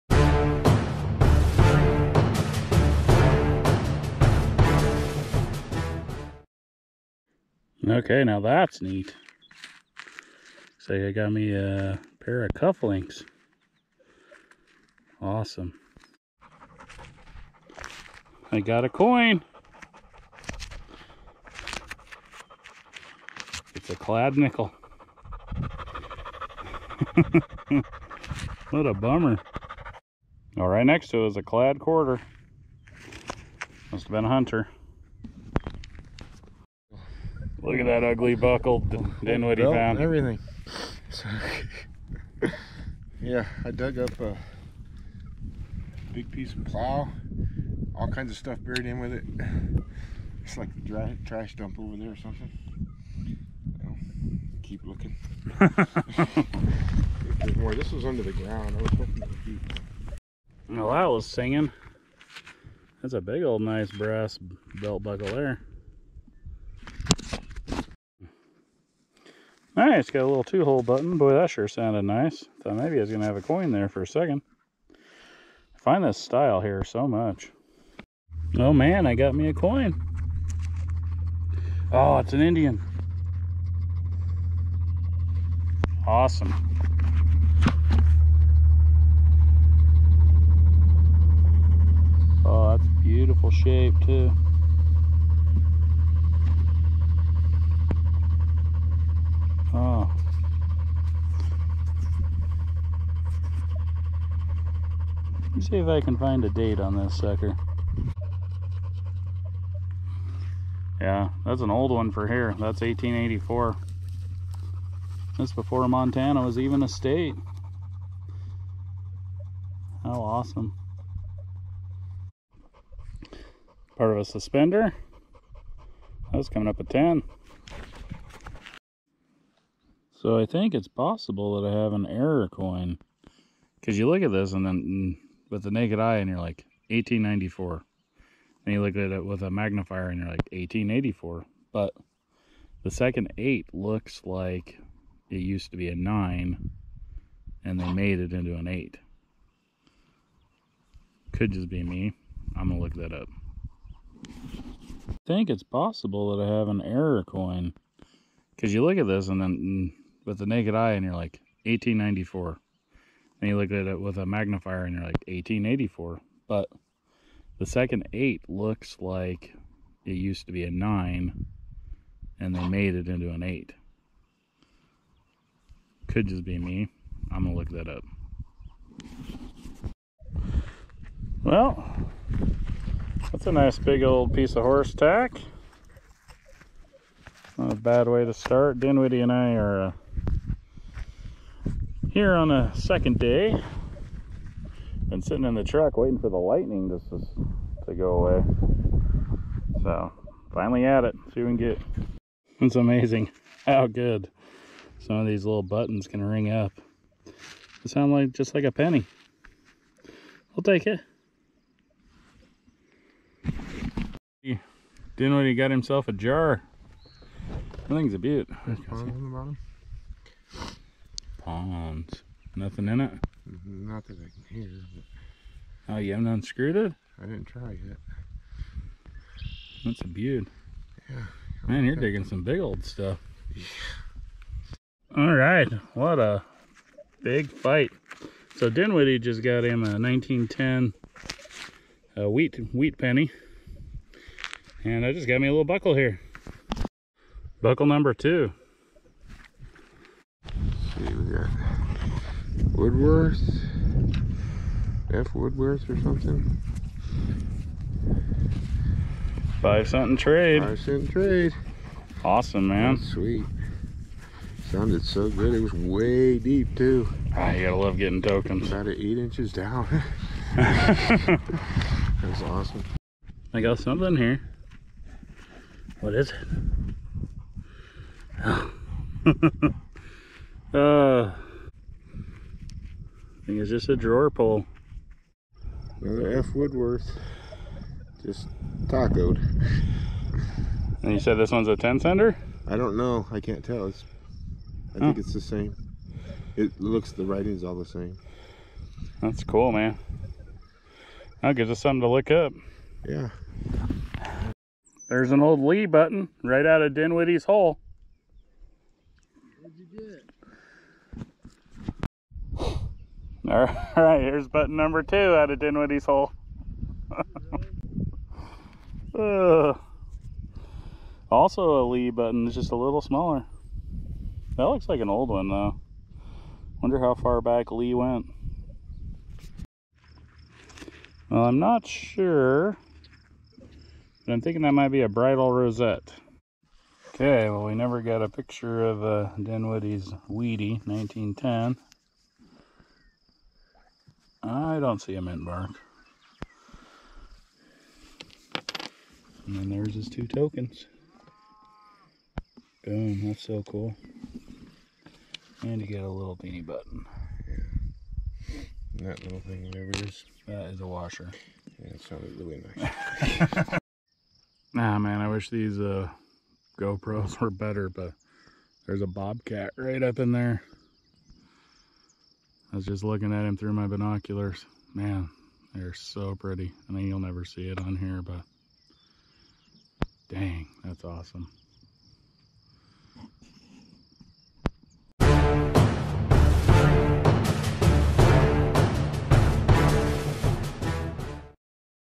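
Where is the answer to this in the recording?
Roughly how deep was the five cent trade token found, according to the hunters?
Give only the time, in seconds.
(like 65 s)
268 s.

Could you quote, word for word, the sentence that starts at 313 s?
All right, here's button number two out of Dinwiddie's hole.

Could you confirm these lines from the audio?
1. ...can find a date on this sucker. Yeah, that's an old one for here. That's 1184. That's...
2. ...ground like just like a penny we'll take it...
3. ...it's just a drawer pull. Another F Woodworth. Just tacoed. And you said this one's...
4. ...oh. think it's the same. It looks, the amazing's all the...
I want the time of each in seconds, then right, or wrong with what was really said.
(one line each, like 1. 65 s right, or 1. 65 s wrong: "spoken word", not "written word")
1. 106 s wrong: "1884", not "1184"
2. 207 s wrong: "sound", not "ground"
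3. 283 s right
4. 295 s wrong: "writing", not "amazing".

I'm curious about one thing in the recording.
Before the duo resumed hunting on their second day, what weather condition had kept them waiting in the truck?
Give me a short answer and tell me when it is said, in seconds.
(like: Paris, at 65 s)
lightning, at 196 s.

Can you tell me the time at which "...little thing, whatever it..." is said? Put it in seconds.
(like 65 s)
359 s.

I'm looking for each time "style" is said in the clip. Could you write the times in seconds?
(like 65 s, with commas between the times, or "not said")
76 s.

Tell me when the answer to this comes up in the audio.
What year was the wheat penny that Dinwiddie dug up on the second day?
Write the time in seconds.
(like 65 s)
239 s.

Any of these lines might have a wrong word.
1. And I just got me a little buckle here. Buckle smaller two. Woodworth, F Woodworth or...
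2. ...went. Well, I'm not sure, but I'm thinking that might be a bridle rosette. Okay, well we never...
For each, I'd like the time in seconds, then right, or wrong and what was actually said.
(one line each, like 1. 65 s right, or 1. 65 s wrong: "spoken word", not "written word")
1. 244 s wrong: "number", not "smaller"
2. 327 s right.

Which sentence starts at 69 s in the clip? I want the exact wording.
All right, it's got a little two-hole button.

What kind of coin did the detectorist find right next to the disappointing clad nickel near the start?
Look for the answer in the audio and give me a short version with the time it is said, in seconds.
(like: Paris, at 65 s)
clad quarter, at 31 s.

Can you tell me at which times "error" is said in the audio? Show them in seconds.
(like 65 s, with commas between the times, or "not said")
132 s, 156 s.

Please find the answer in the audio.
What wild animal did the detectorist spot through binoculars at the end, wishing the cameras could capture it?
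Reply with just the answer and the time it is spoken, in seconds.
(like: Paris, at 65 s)
bobcat, at 369 s.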